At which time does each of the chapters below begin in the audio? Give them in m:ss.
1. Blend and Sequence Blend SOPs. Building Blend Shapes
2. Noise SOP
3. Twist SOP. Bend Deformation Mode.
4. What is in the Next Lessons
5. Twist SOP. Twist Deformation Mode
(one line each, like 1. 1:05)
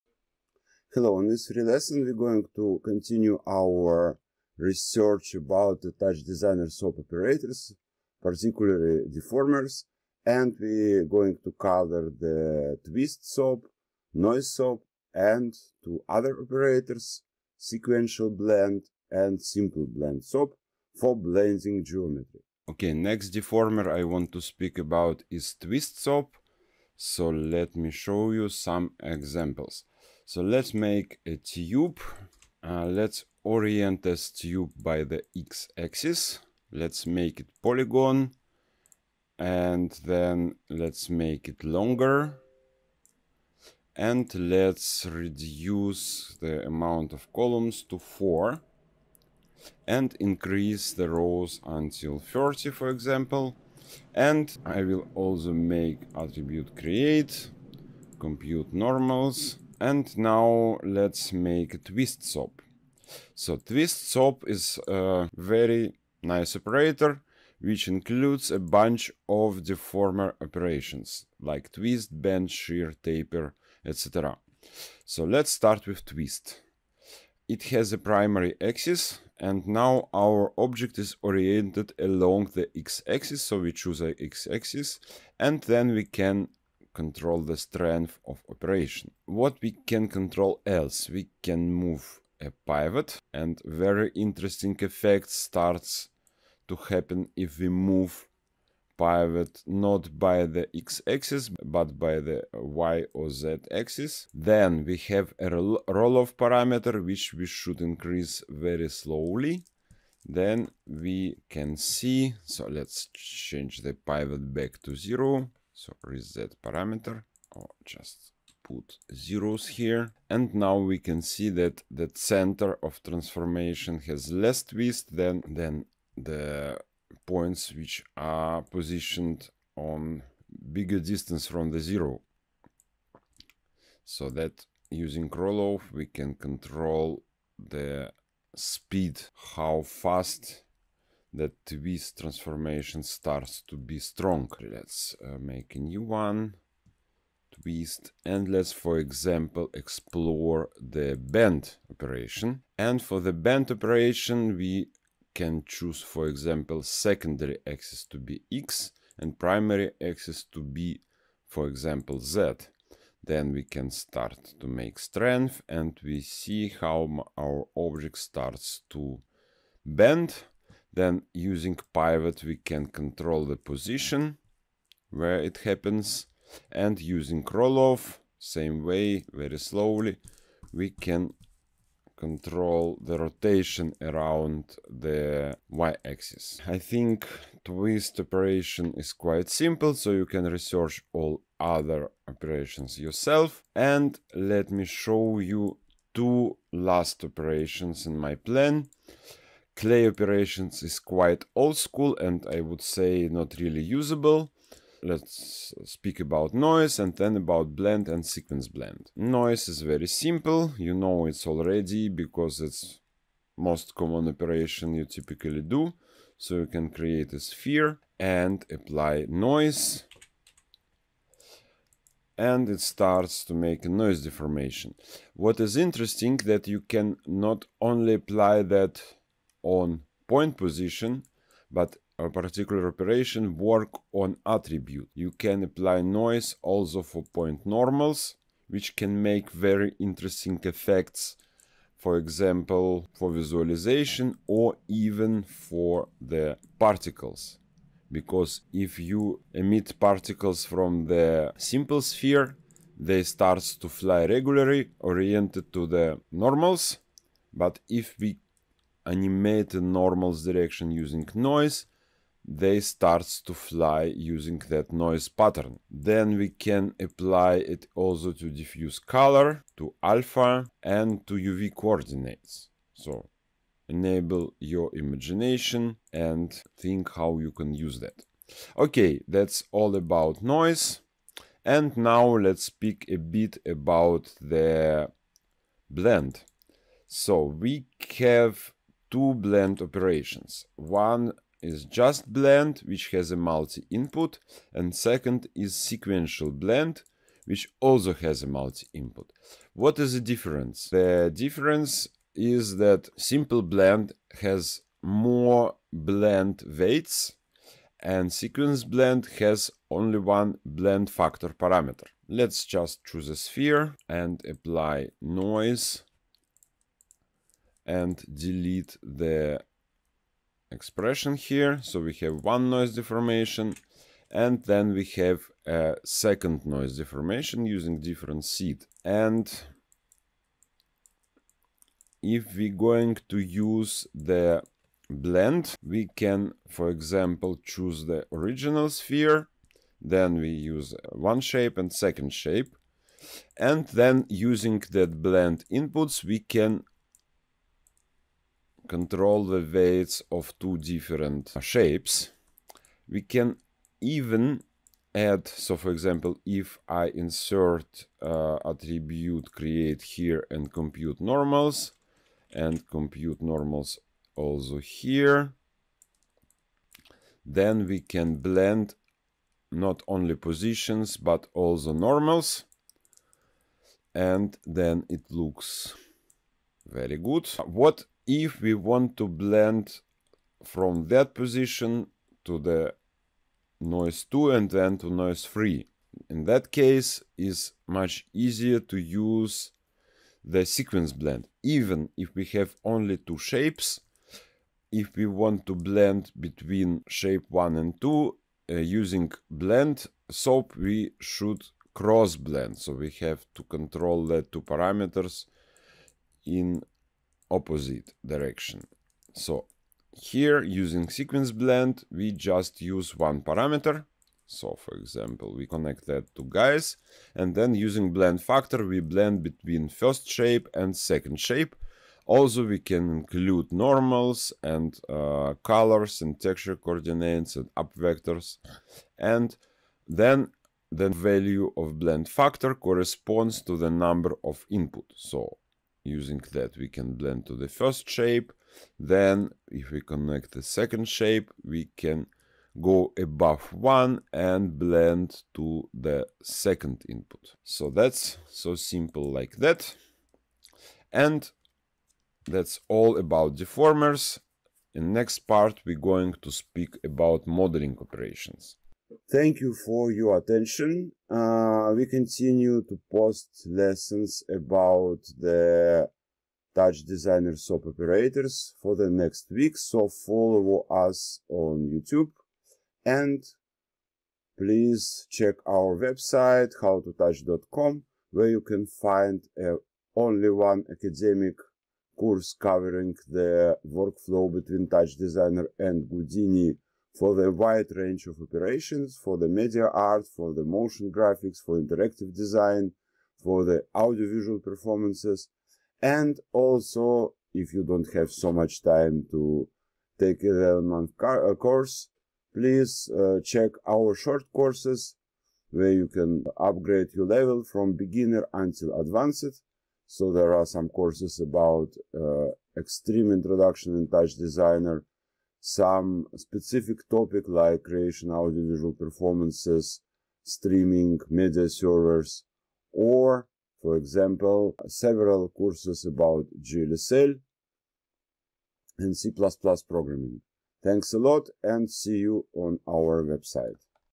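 1. 4:46
2. 3:29
3. 2:32
4. 7:27
5. 0:32.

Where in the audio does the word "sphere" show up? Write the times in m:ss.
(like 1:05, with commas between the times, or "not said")
3:37, 4:12, 5:13, 5:38.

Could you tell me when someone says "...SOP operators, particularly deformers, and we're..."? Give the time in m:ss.
0:06.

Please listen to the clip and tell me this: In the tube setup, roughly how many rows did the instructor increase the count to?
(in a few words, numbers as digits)
30.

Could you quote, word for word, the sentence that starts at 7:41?
Uh, we continue to post lessons about the Touch Designer SOP operators for the next week.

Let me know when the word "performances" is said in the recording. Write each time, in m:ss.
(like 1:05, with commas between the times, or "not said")
8:14, 8:38.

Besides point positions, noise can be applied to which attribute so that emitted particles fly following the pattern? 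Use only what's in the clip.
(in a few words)
Point normals.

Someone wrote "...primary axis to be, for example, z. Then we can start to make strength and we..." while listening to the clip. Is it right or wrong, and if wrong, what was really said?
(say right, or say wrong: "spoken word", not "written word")
right.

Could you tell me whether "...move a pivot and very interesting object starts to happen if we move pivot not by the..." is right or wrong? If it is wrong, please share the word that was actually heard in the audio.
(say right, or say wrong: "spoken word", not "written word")
wrong: "effect", not "object".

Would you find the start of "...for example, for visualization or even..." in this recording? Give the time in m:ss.
4:01.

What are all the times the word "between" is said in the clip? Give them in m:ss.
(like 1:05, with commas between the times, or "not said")
6:36, 6:59, 8:04.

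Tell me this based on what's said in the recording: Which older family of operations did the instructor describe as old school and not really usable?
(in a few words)
Clay operations.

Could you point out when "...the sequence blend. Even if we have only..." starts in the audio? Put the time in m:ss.
6:30.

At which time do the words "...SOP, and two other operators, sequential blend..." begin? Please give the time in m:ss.
0:14.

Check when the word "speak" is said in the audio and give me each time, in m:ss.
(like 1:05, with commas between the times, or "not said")
0:24, 3:25, 4:42, 7:36.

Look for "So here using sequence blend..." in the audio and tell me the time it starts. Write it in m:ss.
6:49.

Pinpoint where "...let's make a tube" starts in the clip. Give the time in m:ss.
0:30.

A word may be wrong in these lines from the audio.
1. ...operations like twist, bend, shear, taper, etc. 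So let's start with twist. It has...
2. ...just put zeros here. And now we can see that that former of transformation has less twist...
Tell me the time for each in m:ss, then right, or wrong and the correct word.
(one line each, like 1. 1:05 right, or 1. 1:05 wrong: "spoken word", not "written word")
1. 1:10 right
2. 1:57 wrong: "center", not "former".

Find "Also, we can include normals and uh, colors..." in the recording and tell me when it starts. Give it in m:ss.
7:02.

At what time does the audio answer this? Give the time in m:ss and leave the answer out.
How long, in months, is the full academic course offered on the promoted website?
8:20.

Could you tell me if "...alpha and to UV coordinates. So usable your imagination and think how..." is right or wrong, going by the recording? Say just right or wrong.
wrong.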